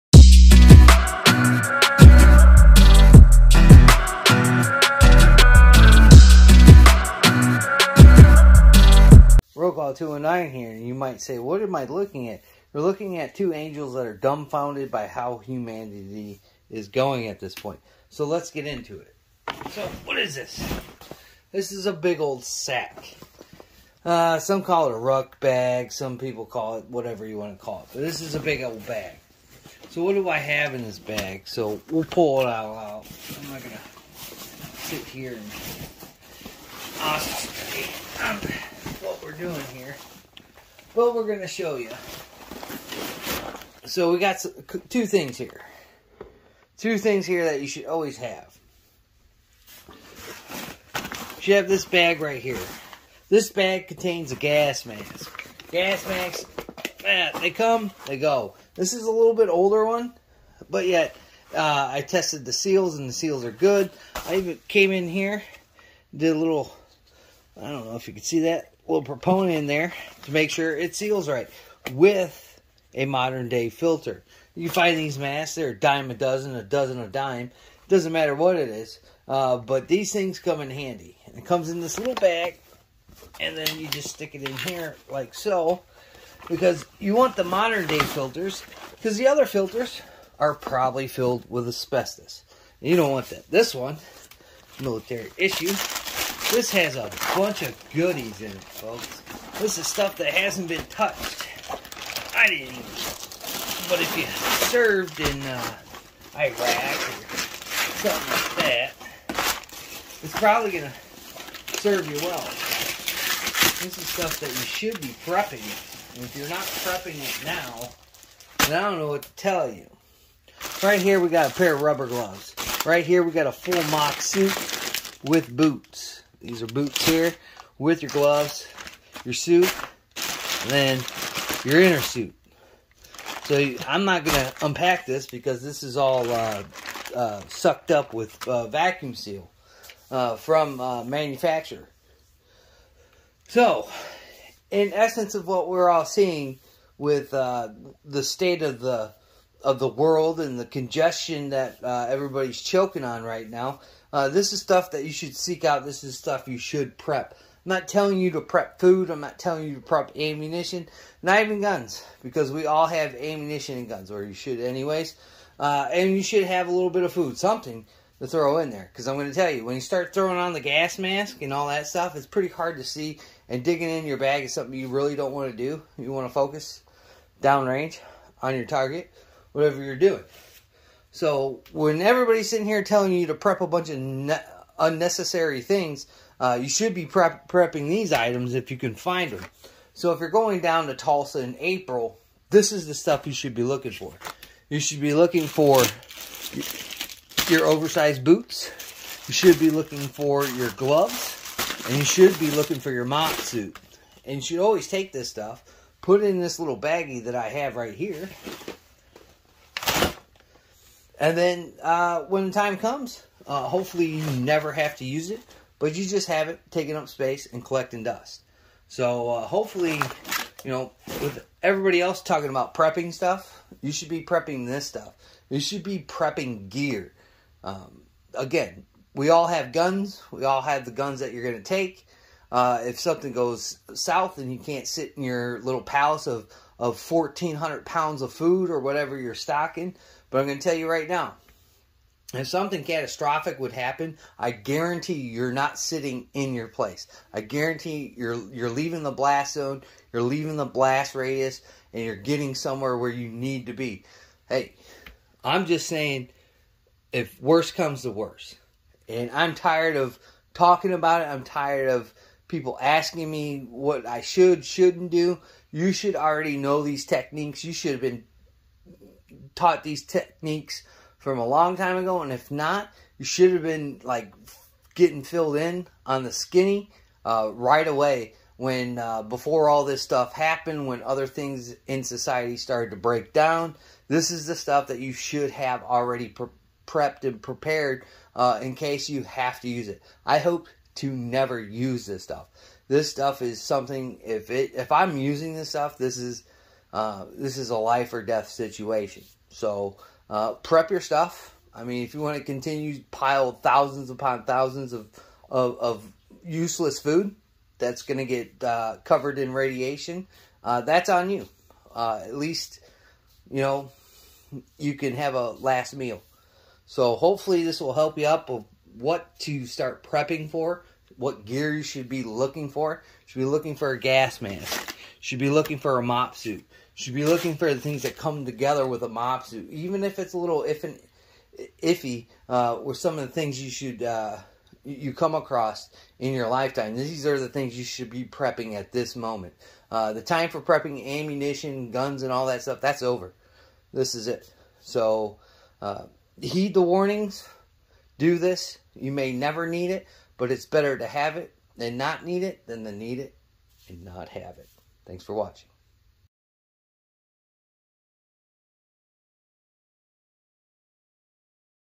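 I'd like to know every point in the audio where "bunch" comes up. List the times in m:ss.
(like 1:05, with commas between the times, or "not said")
1:37, 3:03.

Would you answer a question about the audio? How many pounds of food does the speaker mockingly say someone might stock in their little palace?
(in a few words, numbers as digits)
1,400.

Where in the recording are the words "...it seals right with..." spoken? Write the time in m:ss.
1:10.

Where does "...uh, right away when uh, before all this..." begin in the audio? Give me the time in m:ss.
4:37.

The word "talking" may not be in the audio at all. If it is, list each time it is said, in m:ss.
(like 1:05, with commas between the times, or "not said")
3:42, 4:20.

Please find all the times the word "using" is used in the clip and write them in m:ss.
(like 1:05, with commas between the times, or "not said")
4:55.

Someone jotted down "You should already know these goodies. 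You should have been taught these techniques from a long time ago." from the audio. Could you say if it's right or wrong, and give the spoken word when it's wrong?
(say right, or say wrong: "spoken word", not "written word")
wrong: "techniques", not "goodies".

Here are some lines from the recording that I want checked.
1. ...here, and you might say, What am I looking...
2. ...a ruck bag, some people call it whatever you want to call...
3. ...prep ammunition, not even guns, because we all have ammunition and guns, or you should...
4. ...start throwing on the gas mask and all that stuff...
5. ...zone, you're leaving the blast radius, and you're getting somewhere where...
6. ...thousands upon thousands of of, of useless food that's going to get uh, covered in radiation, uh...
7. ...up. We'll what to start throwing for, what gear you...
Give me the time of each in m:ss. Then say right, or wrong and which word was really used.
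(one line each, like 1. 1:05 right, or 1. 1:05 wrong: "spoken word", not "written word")
1. 0:10 right
2. 0:24 right
3. 2:39 right
4. 2:49 right
5. 4:09 right
6. 5:03 right
7. 5:18 wrong: "prepping", not "throwing".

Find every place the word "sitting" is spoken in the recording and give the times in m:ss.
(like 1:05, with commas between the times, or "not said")
3:02, 4:05.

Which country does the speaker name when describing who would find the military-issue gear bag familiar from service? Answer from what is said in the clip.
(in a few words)
Iraq.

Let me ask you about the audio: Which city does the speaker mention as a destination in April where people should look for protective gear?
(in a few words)
Tulsa.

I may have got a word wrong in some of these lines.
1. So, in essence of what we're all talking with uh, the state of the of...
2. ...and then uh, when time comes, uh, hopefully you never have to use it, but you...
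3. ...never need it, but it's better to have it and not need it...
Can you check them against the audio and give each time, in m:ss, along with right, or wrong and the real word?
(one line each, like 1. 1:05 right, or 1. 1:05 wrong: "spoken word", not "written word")
1. 2:23 wrong: "seeing", not "talking"
2. 3:31 right
3. 5:49 right.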